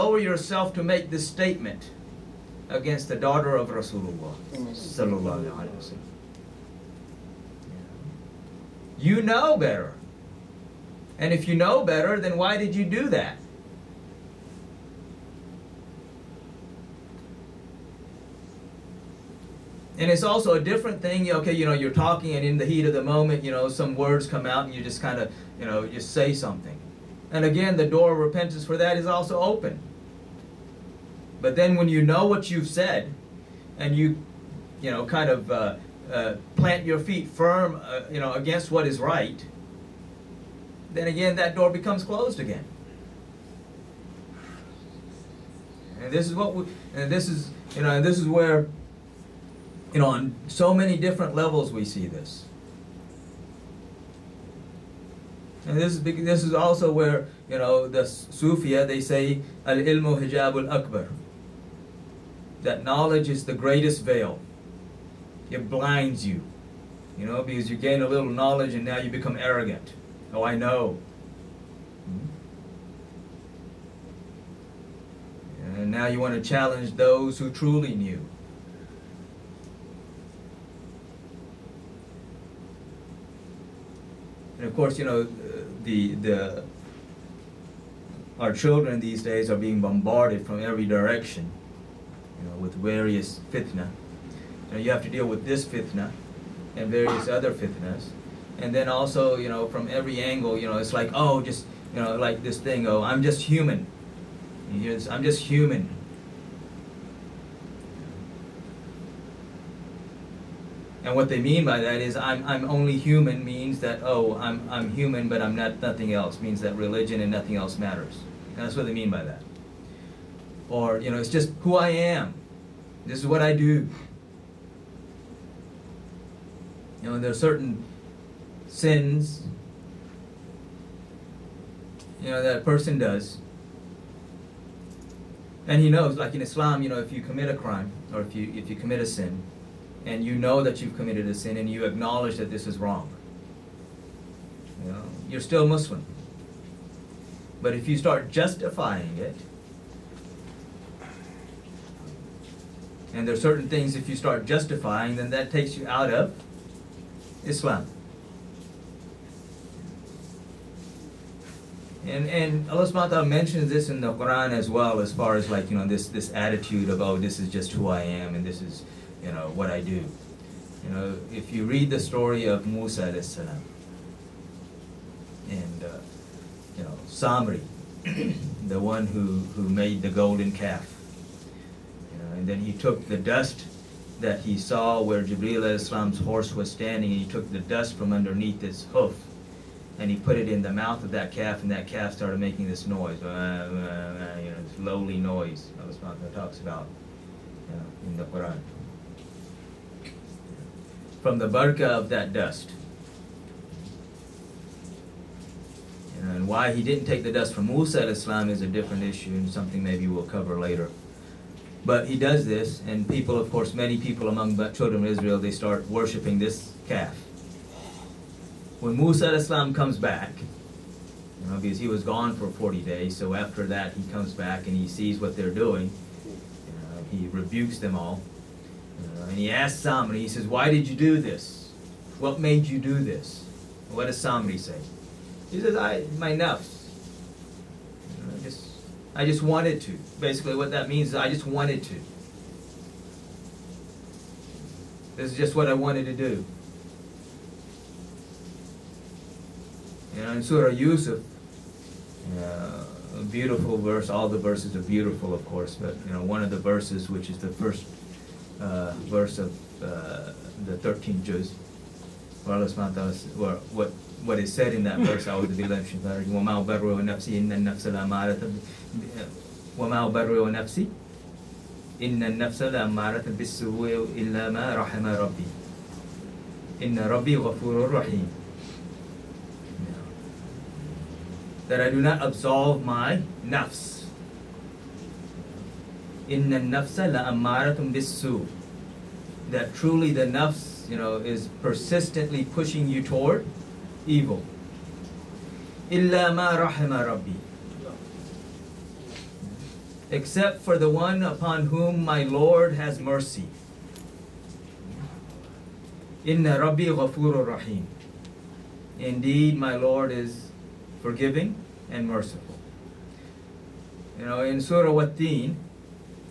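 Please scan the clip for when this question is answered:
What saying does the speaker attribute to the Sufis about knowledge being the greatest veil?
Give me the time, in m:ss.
0:59.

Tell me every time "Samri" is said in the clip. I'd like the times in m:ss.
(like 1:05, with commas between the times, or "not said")
2:57, 3:49, 3:54.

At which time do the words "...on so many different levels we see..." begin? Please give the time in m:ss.
0:50.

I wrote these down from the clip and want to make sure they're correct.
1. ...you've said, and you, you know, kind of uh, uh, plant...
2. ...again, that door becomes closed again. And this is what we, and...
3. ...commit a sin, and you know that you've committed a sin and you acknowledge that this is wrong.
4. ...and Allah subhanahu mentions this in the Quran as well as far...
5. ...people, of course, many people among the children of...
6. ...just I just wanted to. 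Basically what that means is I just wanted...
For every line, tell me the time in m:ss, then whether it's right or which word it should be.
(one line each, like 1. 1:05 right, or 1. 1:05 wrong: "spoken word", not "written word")
1. 0:32 right
2. 0:41 right
3. 2:18 right
4. 2:42 right
5. 3:33 right
6. 3:58 right.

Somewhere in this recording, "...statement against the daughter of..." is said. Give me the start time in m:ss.
0:01.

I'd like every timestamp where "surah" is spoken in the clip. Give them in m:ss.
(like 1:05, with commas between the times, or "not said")
4:10, 5:14.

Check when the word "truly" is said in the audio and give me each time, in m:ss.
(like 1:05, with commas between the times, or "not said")
1:17, 4:49.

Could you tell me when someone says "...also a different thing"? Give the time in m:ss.
0:20.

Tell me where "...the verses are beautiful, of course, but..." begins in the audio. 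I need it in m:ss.
4:14.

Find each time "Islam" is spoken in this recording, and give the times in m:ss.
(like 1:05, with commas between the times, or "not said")
2:16, 2:37, 3:05, 3:28, 3:39.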